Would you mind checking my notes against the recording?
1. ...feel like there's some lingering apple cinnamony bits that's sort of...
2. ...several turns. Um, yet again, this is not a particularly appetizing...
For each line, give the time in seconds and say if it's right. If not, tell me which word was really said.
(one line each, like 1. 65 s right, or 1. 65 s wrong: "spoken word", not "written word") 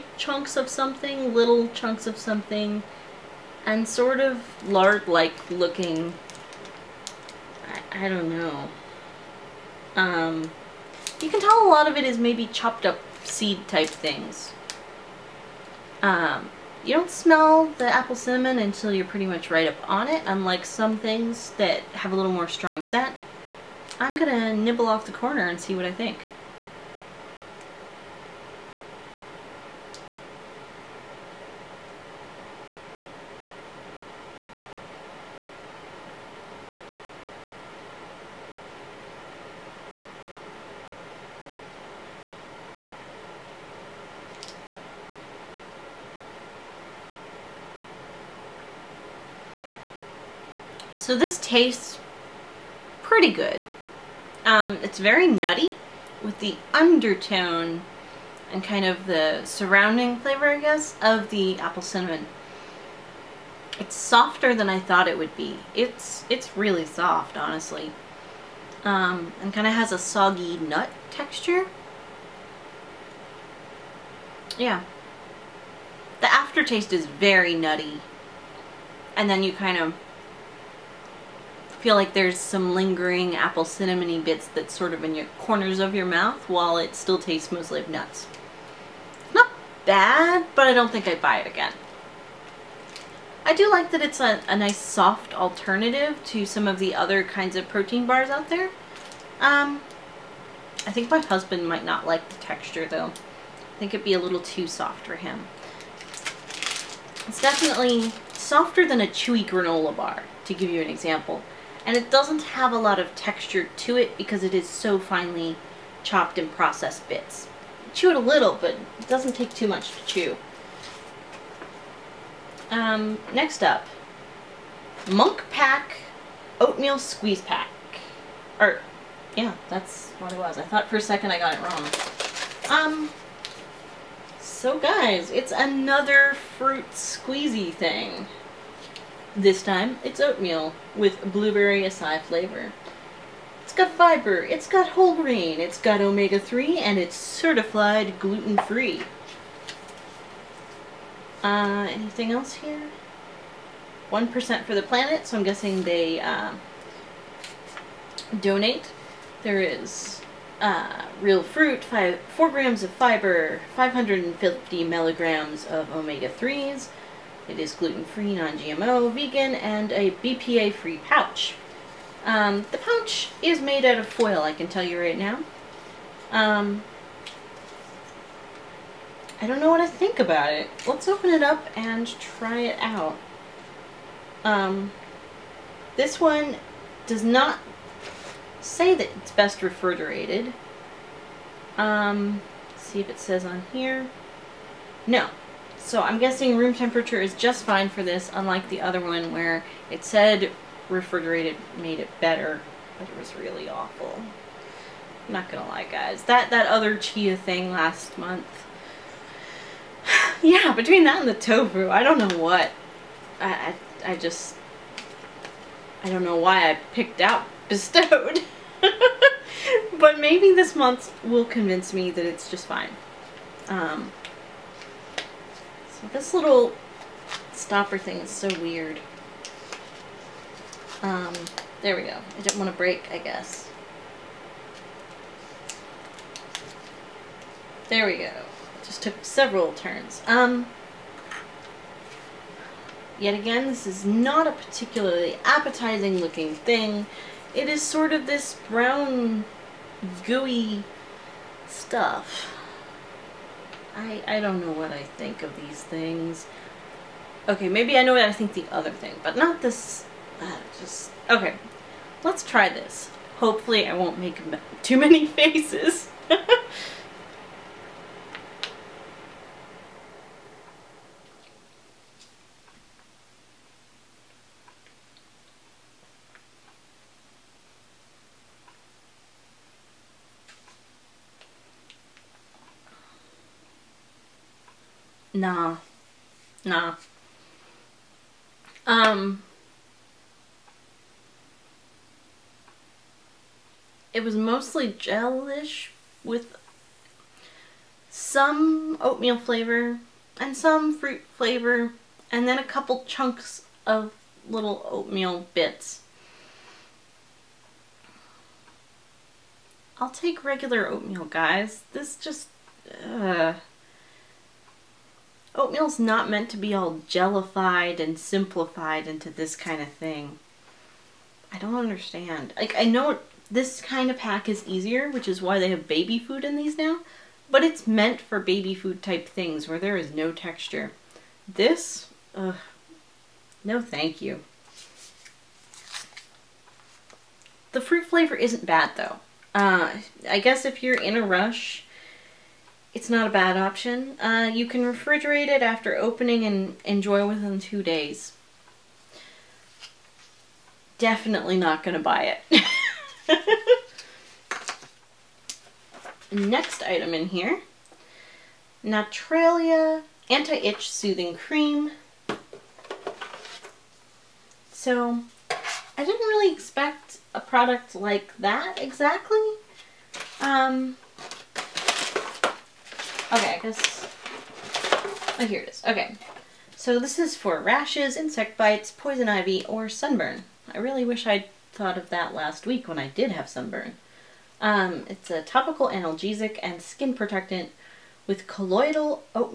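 1. 81 s right
2. 239 s right.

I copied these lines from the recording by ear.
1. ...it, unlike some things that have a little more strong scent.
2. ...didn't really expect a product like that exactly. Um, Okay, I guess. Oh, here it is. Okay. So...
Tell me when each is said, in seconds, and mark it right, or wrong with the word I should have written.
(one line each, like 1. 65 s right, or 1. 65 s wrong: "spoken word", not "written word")
1. 20 s right
2. 366 s right.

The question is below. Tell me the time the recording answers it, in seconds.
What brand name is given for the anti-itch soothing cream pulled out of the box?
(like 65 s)
358 s.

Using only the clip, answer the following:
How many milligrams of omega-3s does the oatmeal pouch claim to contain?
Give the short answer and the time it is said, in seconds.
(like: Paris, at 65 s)
550, at 163 s.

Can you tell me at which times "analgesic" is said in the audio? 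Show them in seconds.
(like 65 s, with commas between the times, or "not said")
385 s.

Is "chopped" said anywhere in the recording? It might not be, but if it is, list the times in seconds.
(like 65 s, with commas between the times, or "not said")
12 s, 116 s.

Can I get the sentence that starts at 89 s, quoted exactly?
Not bad, but I don't think I'd buy it again.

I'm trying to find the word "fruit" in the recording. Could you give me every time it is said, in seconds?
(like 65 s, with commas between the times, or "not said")
136 s, 161 s, 300 s, 337 s.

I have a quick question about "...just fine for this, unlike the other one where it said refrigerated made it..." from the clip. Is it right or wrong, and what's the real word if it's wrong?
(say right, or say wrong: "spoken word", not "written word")
right.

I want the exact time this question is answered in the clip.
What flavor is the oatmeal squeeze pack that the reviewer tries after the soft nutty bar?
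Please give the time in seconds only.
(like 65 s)
141 s.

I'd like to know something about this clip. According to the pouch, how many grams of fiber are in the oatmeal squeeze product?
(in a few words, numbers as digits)
4.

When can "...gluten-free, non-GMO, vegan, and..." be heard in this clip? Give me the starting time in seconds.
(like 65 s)
167 s.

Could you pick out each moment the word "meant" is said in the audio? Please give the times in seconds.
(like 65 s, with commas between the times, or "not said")
316 s, 327 s.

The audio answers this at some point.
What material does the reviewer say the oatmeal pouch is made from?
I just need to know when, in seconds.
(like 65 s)
174 s.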